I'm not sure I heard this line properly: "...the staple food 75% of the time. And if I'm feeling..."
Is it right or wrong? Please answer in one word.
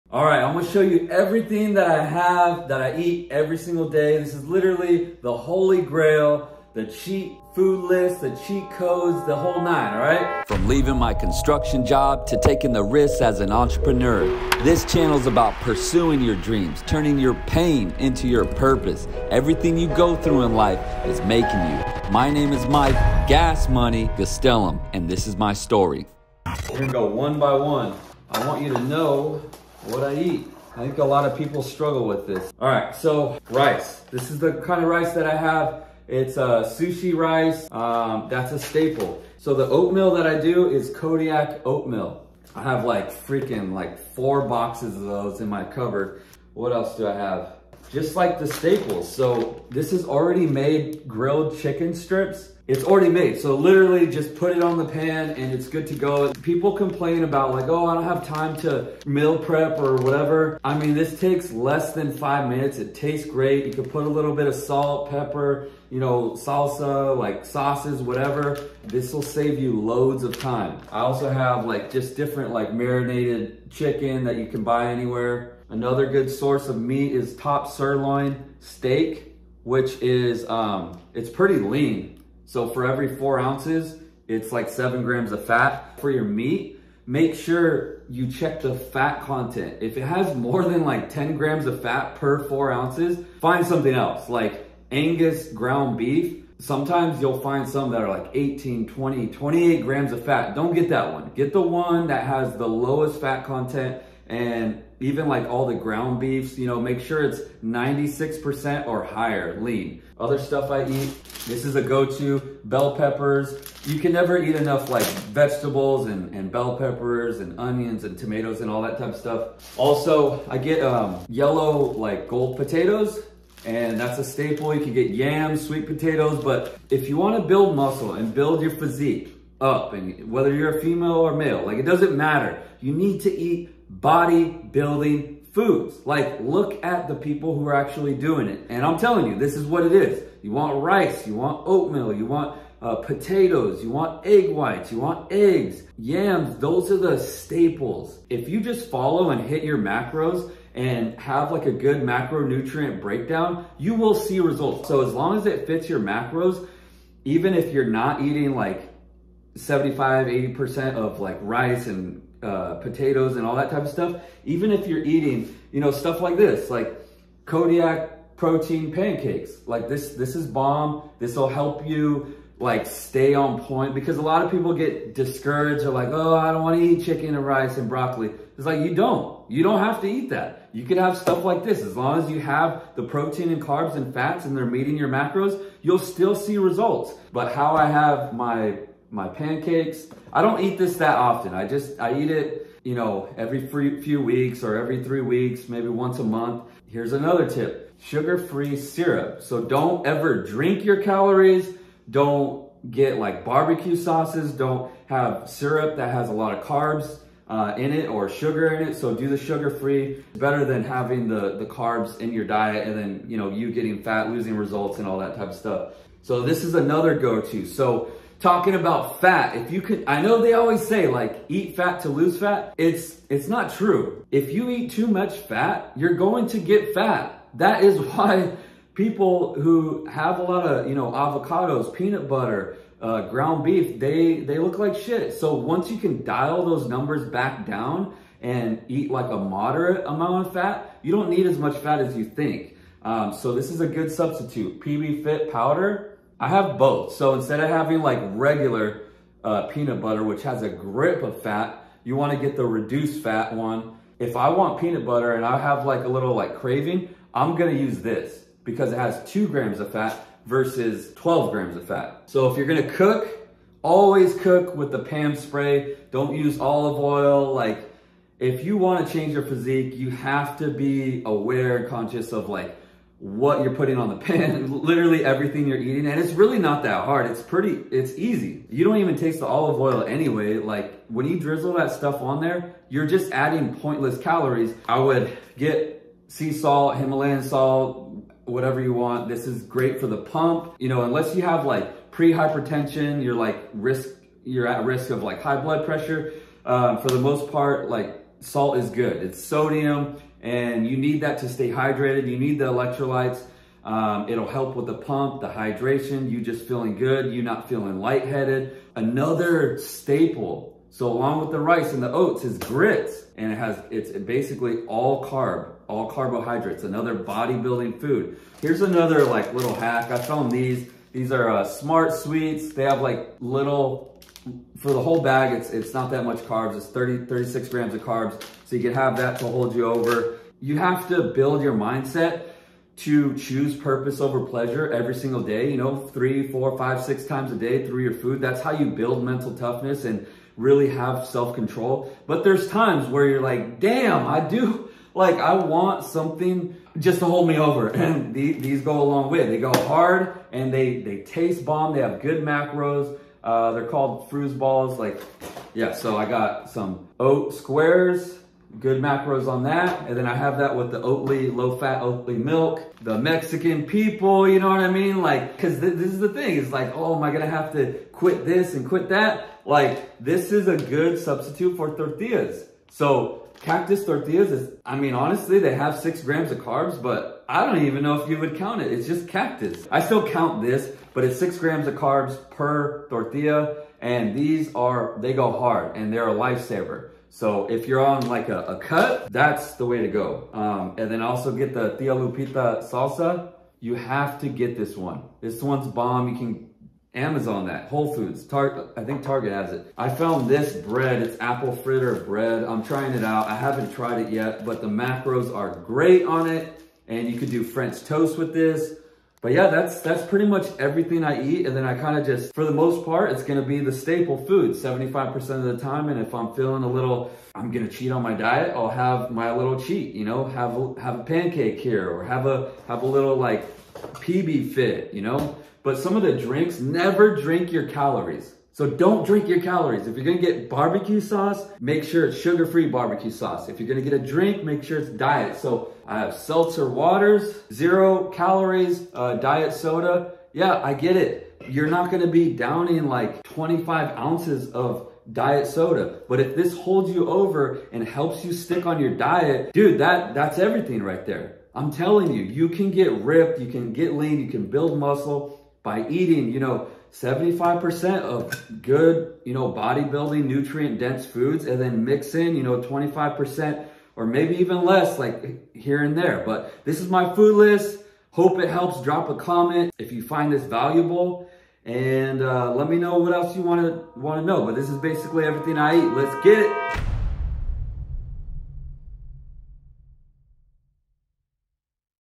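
right.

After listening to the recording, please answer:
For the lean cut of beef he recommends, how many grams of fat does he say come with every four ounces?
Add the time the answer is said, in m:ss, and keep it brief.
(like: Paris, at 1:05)
7, at 1:24.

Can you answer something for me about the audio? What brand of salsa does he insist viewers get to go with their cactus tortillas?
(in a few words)
Tia Lupita.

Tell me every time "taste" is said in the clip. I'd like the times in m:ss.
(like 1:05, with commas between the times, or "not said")
1:02, 4:39, 5:51.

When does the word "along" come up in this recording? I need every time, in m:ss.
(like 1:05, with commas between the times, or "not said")
5:11.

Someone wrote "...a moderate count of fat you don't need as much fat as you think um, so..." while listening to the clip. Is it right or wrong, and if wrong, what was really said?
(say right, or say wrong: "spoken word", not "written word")
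wrong: "amount", not "count".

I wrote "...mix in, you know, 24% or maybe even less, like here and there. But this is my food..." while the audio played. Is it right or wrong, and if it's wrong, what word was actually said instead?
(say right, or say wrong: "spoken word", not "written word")
wrong: "25", not "24".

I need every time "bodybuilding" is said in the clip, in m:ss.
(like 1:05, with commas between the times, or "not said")
2:13, 5:17, 7:39.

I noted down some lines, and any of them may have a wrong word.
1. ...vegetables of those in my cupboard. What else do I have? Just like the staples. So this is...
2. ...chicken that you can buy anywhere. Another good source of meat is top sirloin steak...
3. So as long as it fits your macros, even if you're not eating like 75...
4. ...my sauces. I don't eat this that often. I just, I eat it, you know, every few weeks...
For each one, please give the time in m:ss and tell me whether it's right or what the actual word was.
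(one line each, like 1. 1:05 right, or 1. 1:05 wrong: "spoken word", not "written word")
1. 0:44 wrong: "boxes", not "vegetables"
2. 1:13 right
3. 2:34 right
4. 3:09 wrong: "pancakes", not "sauces".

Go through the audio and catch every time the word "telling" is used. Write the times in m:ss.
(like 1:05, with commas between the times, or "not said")
2:18, 7:31.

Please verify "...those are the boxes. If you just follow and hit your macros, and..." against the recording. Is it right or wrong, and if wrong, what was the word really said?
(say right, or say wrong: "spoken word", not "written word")
wrong: "staples", not "boxes".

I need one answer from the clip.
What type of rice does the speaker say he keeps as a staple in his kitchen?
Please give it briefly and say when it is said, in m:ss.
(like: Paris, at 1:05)
Sushi rice, at 0:36.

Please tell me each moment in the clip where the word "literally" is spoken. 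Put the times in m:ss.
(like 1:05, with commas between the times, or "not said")
0:04, 0:53, 4:34.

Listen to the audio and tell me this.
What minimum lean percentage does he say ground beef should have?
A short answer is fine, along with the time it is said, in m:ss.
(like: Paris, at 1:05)
96%, at 1:47.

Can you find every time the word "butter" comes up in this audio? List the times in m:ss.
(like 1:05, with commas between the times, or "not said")
3:52, 4:10, 4:15.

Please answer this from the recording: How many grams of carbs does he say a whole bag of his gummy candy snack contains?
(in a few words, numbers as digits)
36.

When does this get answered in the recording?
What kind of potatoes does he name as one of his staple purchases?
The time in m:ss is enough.
2:02.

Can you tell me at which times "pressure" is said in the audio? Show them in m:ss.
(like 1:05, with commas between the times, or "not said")
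4:55.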